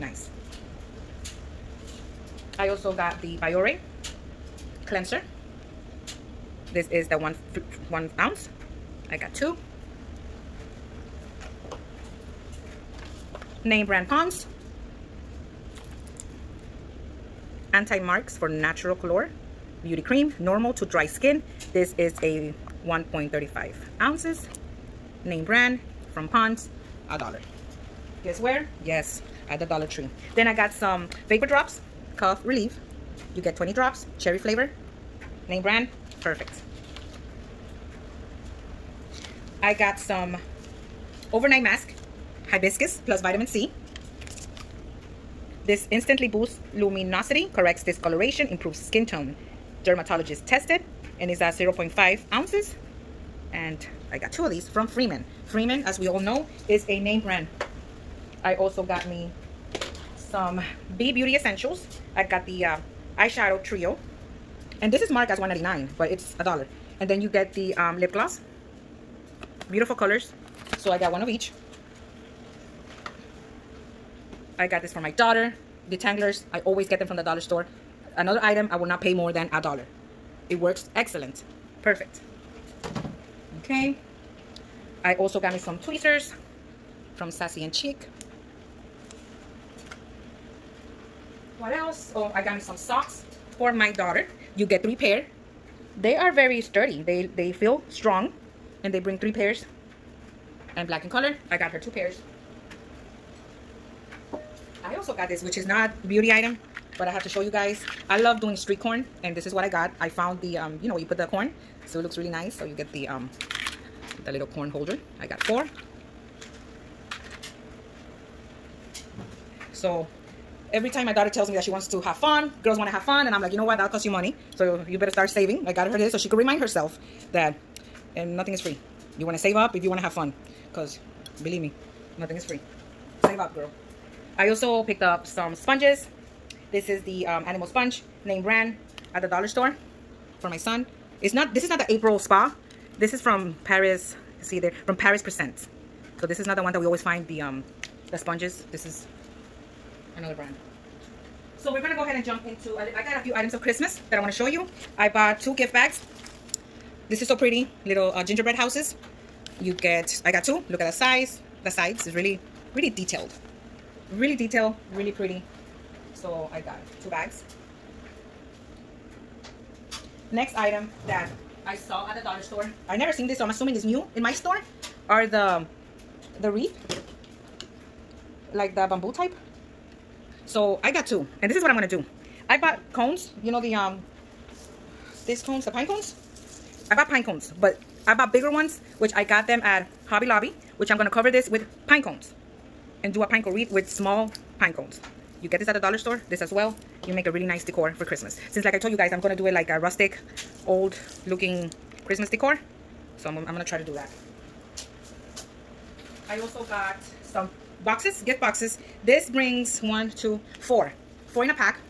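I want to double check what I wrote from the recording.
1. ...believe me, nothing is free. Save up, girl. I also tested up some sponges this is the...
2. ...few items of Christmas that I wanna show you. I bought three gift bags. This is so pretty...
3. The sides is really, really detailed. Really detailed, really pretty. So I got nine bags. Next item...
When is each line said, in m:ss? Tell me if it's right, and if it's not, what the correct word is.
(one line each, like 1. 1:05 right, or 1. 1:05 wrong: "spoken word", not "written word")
1. 2:11 wrong: "picked", not "tested"
2. 2:33 wrong: "two", not "three"
3. 2:41 wrong: "two", not "nine".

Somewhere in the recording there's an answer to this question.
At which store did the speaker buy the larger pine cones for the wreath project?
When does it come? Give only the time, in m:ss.
3:10.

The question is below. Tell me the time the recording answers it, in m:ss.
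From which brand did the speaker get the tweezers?
1:27.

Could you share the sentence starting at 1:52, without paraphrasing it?
So you get the, um, the little corn holder.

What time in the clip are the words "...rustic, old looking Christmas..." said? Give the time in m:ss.
3:19.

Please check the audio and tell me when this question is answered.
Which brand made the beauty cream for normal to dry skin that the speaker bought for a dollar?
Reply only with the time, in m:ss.
0:26.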